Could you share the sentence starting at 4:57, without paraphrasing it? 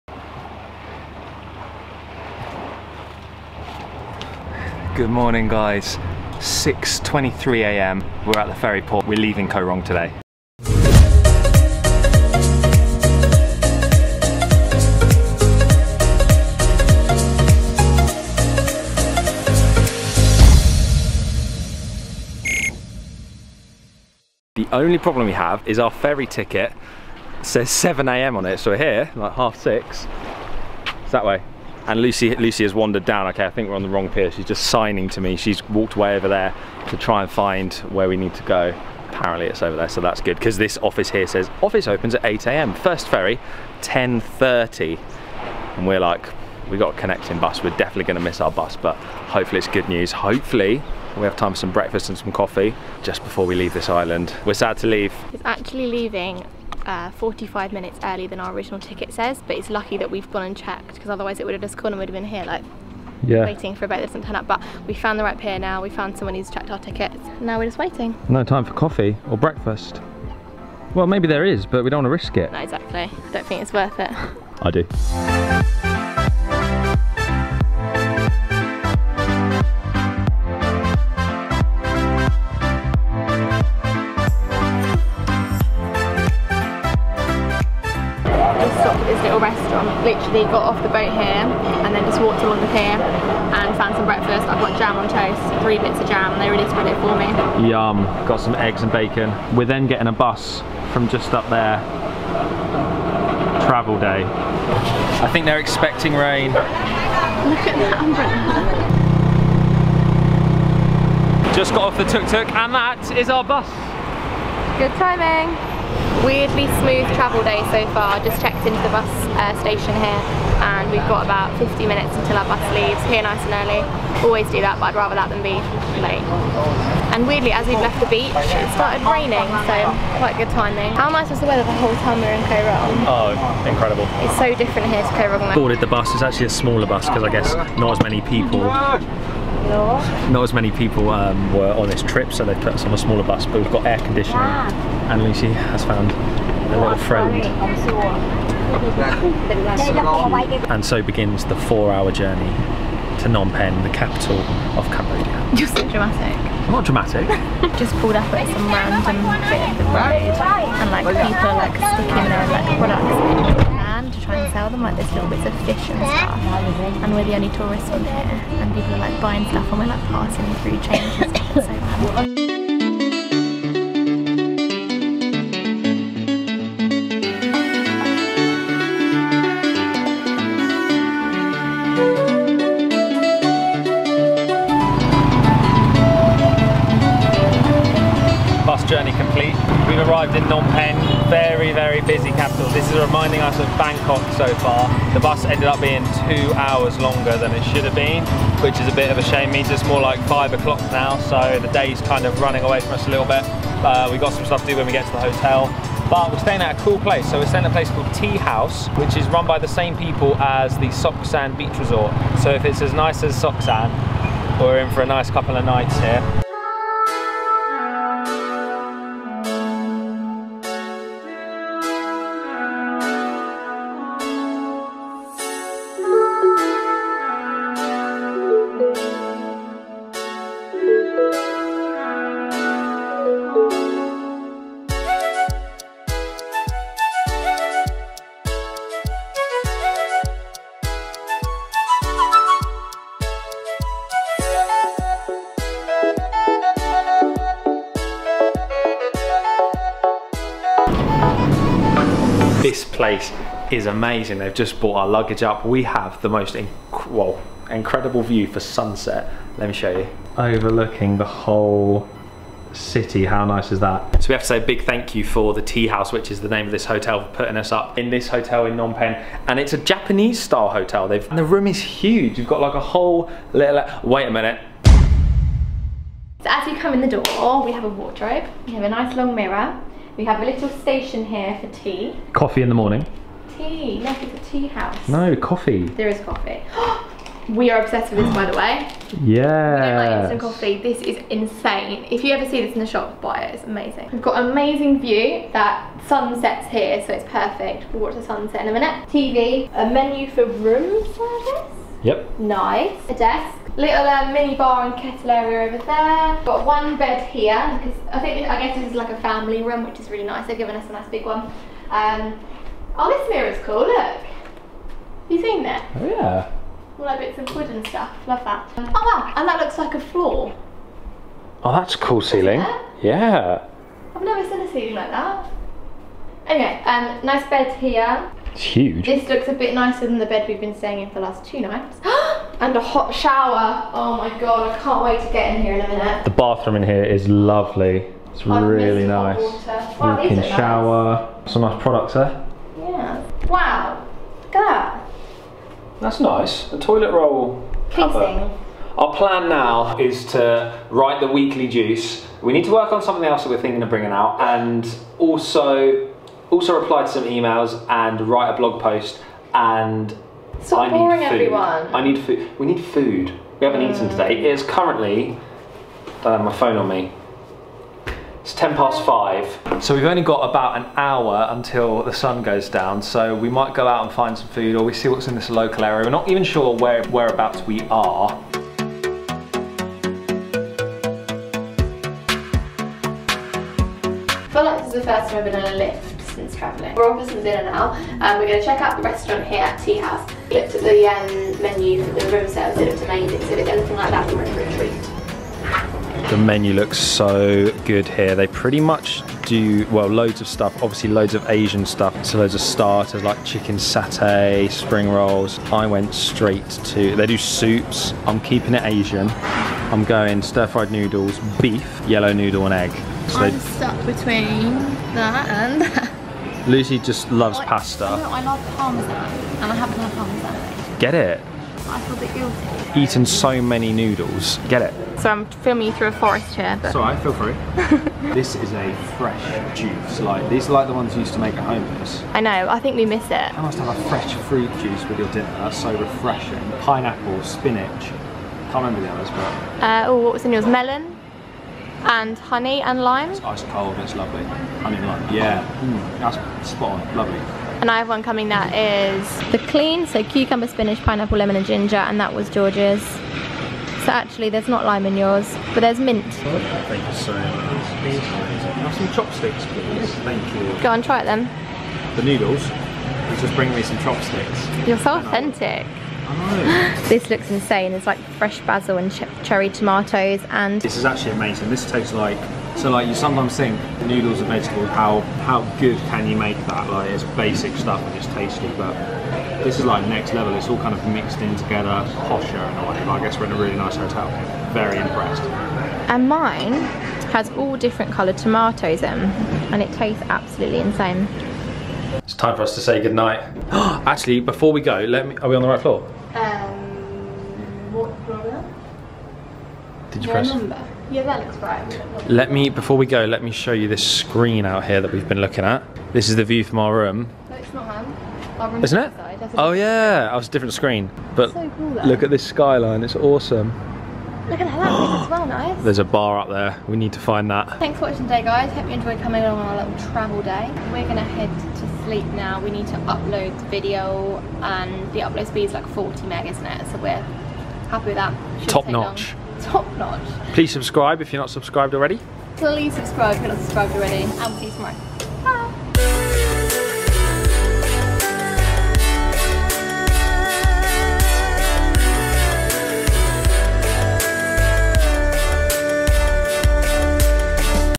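We'll watch the sunset in a minute.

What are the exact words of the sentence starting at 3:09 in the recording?
We've arrived in Phnom Penh, very, very busy capital.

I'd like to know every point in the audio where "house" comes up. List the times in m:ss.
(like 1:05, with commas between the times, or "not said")
3:28, 4:25, 4:44, 6:29.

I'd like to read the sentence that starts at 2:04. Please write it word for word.
Always do that but I'd rather that than be late.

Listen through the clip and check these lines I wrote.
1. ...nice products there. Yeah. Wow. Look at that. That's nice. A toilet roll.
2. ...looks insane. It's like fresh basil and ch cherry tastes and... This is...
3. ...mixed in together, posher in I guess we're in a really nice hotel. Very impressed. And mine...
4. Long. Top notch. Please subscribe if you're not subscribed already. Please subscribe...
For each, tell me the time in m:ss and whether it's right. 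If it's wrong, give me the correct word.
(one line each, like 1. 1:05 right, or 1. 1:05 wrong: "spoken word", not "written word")
1. 5:41 right
2. 7:47 wrong: "tomatoes", not "tastes"
3. 8:01 right
4. 8:49 right.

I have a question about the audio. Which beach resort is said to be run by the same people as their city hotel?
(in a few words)
Soksan Beach Resort.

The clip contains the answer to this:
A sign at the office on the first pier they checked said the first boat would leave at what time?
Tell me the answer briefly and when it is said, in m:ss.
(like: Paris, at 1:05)
10:30, at 0:43.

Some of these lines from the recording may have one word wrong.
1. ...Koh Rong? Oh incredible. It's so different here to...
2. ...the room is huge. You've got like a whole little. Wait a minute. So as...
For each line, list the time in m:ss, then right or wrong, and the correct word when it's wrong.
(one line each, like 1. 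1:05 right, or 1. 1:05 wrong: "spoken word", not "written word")
1. 2:12 right
2. 4:31 right.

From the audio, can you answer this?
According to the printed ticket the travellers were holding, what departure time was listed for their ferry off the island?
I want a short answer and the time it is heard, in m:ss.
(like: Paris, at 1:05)
7 a.m., at 0:27.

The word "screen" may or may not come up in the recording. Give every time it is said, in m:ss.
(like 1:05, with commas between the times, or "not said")
8:24, 8:30.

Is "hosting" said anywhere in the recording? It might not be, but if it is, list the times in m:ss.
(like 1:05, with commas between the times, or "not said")
not said.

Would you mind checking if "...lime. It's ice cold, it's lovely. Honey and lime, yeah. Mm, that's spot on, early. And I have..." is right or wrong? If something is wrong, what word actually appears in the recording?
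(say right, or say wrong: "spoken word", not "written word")
wrong: "lovely", not "early".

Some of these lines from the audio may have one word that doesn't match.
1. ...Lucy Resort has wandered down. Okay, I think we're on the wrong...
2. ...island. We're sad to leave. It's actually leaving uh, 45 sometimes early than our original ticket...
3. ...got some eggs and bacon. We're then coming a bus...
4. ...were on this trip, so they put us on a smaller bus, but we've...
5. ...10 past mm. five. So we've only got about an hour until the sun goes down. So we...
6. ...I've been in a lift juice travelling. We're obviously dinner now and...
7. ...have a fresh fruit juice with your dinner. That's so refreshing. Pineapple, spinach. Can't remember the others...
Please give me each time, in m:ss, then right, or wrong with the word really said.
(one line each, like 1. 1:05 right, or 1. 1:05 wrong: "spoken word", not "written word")
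1. 0:32 wrong: "Lucy", not "Resort"
2. 0:53 wrong: "minutes", not "sometimes"
3. 1:38 wrong: "getting", not "coming"
4. 2:21 right
5. 6:08 right
6. 6:25 wrong: "since", not "juice"
7. 7:13 right.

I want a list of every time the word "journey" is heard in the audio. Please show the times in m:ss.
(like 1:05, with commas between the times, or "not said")
2:32, 3:08.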